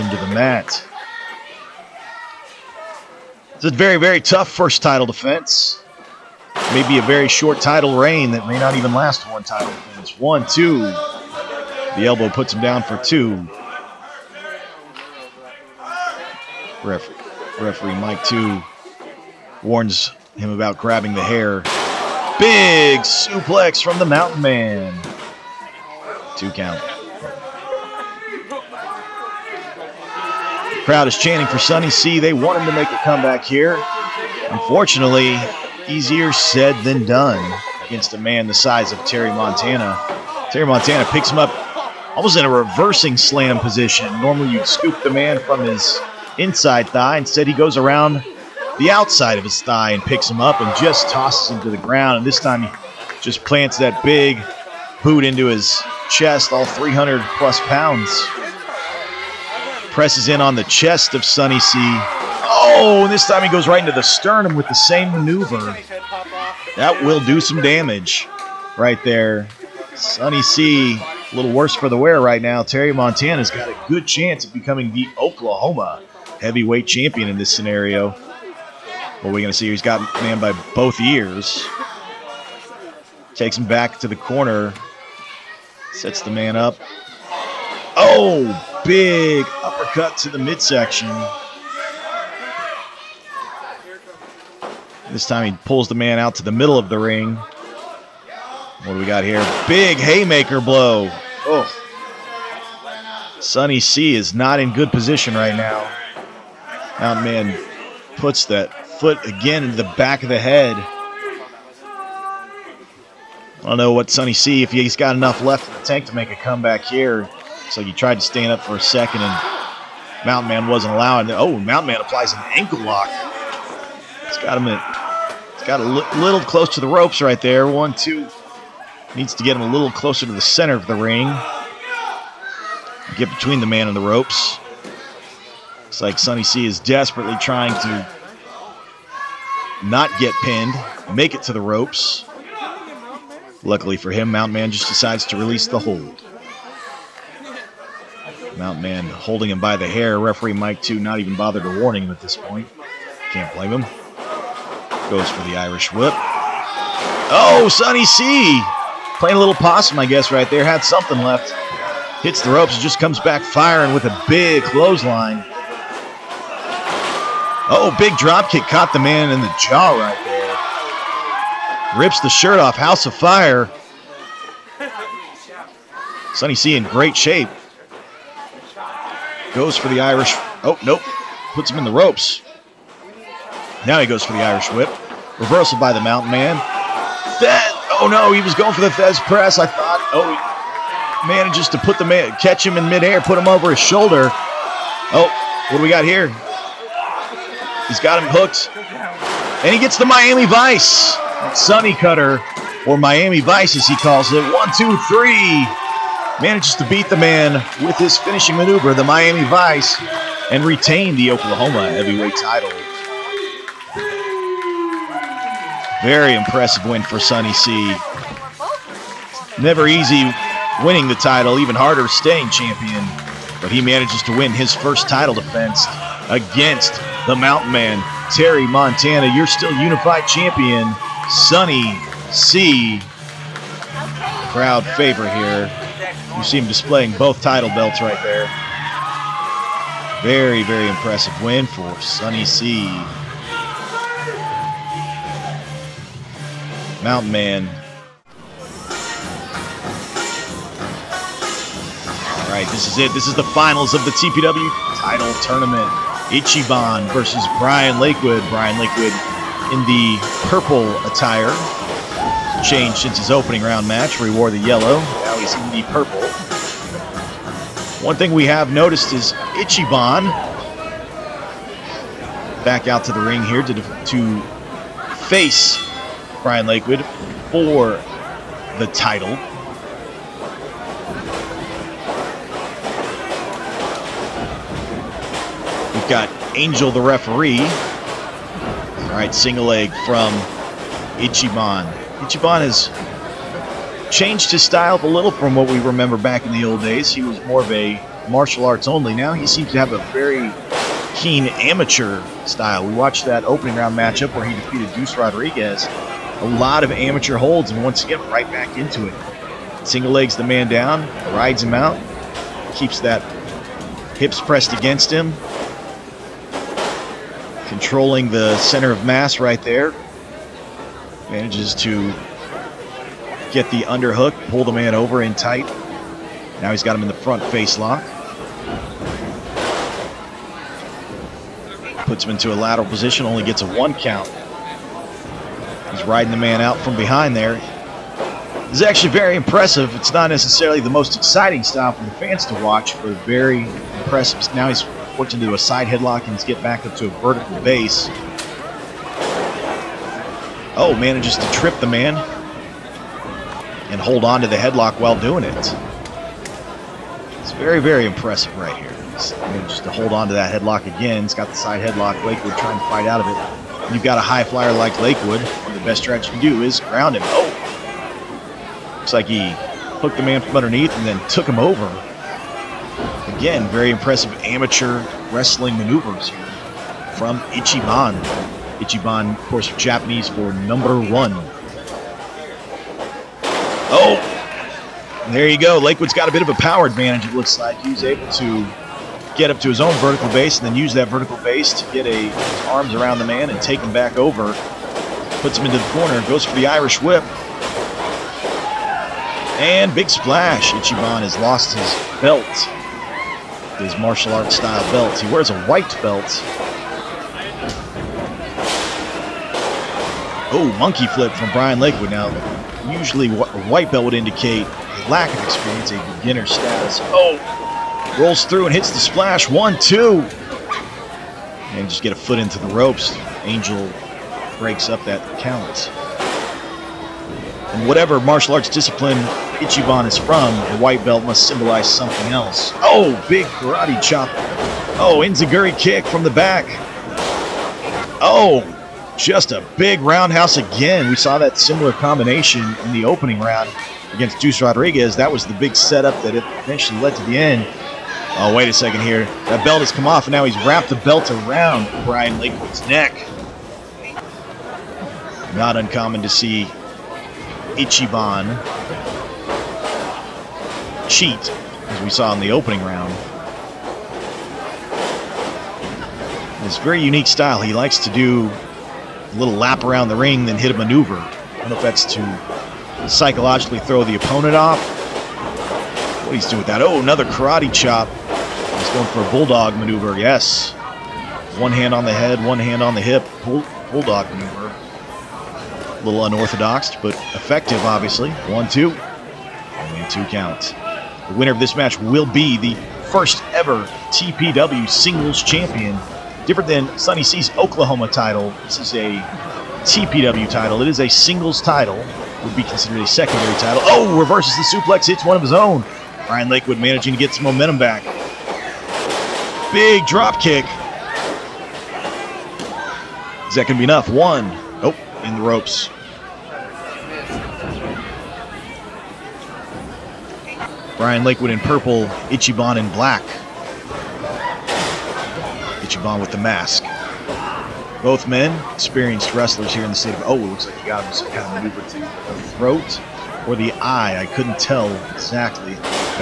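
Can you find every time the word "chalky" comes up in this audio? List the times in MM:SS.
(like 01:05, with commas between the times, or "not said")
not said.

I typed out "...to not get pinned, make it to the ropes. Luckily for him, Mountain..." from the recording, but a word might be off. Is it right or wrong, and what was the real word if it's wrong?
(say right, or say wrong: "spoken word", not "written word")
right.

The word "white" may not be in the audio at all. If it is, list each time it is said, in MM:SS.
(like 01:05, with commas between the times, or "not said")
06:45, 06:53, 07:10.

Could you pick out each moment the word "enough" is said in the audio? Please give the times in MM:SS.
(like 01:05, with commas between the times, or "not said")
01:55, 08:33.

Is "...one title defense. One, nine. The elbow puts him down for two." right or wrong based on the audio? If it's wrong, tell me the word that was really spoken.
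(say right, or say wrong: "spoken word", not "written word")
wrong: "two", not "nine".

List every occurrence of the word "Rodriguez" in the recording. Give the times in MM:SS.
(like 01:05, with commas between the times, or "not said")
05:05, 07:24.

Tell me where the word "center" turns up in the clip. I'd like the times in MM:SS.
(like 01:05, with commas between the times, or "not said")
02:10, 05:18.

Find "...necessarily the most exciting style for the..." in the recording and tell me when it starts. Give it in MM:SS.
05:40.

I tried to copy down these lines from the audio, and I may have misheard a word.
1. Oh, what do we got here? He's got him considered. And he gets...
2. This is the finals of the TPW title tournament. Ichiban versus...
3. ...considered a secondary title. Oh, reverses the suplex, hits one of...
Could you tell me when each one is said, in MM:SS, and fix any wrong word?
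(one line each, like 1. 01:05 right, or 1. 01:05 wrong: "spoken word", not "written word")
1. 03:15 wrong: "hooked", not "considered"
2. 04:13 right
3. 08:22 right.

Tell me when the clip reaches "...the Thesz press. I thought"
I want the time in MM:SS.
03:08.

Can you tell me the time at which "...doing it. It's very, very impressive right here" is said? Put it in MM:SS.
05:55.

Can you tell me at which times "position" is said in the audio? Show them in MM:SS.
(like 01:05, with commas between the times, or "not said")
00:43, 01:44, 05:32.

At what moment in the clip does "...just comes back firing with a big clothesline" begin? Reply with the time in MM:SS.
02:42.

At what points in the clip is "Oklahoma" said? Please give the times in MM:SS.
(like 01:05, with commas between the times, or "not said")
01:15, 03:31, 08:17.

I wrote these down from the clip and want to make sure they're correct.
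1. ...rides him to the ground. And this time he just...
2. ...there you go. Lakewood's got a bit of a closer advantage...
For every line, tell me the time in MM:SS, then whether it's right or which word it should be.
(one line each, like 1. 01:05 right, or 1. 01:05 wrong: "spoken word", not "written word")
1. 00:51 wrong: "tosses", not "rides"
2. 06:25 wrong: "power", not "closer".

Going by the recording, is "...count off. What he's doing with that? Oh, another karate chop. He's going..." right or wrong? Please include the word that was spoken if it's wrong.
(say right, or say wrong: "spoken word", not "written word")
wrong: "opponent", not "count".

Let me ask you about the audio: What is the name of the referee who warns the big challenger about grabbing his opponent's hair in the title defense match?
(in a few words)
Mike Two.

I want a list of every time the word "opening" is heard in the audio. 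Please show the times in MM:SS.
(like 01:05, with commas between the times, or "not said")
04:23, 05:03, 07:23, 07:42.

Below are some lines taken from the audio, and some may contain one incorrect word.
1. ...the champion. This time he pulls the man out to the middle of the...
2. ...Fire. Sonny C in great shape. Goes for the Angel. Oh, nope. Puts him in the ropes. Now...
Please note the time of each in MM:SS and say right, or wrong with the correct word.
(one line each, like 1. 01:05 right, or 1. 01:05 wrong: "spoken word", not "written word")
1. 01:30 wrong: "midsection", not "champion"
2. 02:53 wrong: "Irish", not "Angel".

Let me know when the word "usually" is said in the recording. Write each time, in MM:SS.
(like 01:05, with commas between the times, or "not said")
06:52.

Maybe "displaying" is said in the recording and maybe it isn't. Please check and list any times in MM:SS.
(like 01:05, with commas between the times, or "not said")
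03:56.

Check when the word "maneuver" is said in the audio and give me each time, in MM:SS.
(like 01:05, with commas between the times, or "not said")
01:05, 03:28, 06:15, 07:50, 07:59, 08:04.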